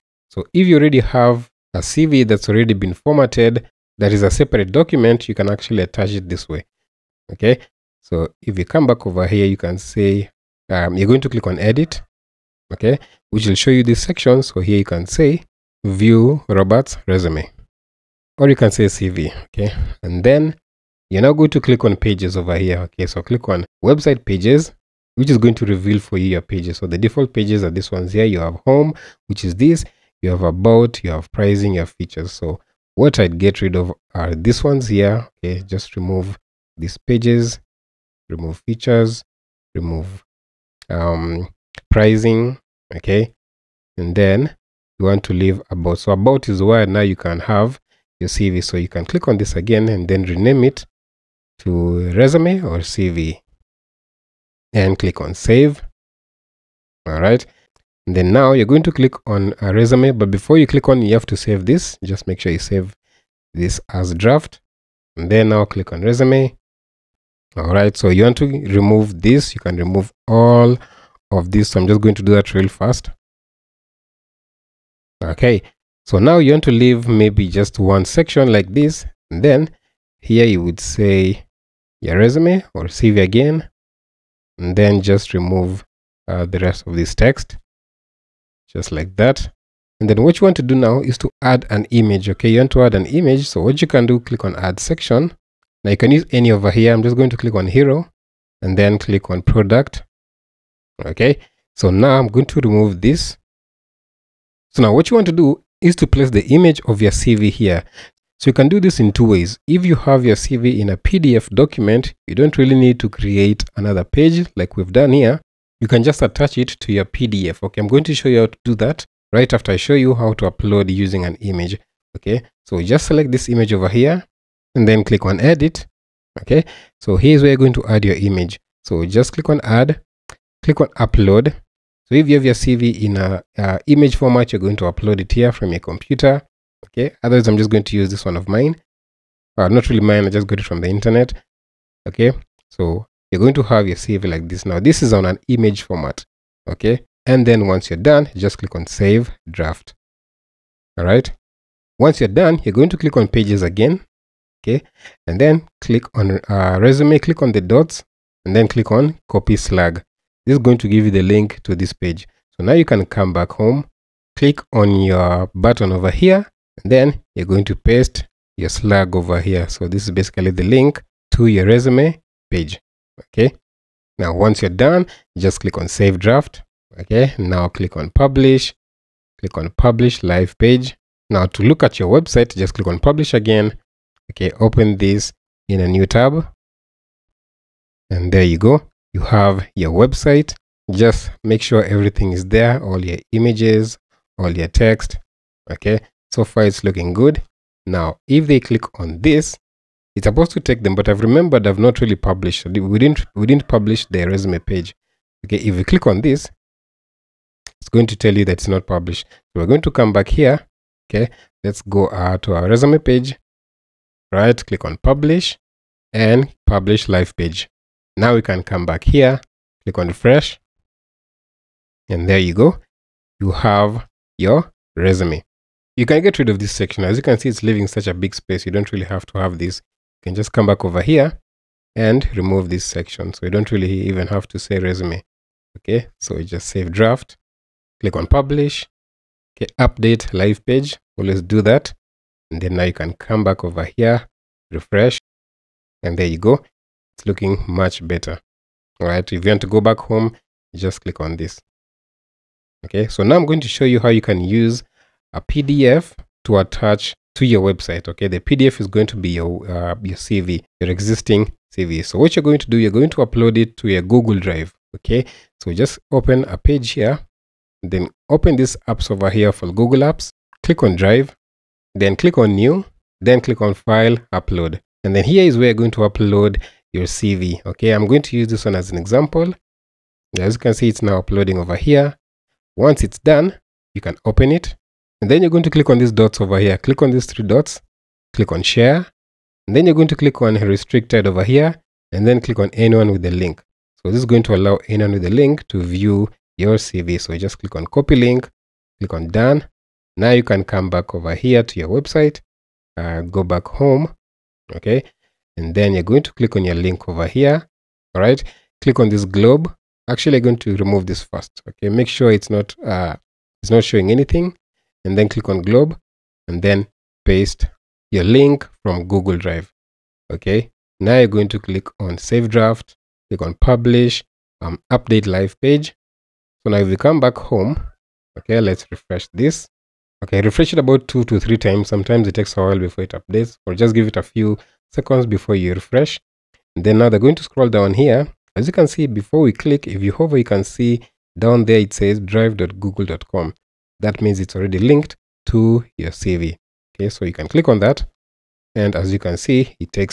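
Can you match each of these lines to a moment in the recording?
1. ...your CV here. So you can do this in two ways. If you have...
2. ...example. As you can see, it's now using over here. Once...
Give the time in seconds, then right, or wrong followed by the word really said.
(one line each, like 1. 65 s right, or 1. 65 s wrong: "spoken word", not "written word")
1. 107 s right
2. 278 s wrong: "uploading", not "using".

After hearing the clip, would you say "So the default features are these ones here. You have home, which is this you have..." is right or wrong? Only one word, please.
wrong.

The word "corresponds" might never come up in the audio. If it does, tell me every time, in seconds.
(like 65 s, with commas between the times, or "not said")
not said.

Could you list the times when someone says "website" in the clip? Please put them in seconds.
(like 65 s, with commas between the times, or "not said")
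23 s, 182 s, 189 s, 257 s, 301 s.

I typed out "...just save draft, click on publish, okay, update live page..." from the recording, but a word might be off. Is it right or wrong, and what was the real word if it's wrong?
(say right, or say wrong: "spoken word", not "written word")
right.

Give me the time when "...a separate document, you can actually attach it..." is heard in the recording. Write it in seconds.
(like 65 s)
4 s.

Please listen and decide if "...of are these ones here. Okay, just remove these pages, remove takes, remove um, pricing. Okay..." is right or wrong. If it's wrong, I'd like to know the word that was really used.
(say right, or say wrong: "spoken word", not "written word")
wrong: "features", not "takes".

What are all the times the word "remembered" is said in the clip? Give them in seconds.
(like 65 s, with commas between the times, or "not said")
201 s.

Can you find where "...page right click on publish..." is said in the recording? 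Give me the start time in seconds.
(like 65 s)
212 s.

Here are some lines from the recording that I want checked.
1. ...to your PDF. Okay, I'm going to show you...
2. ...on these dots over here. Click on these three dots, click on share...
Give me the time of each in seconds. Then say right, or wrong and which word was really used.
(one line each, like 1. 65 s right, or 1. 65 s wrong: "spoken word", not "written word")
1. 116 s right
2. 285 s right.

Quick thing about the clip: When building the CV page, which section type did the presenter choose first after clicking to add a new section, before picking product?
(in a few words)
Hero.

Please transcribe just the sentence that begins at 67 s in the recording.
All right, so you want to remove this.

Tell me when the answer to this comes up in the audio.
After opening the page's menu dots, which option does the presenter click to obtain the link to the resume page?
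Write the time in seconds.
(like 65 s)
159 s.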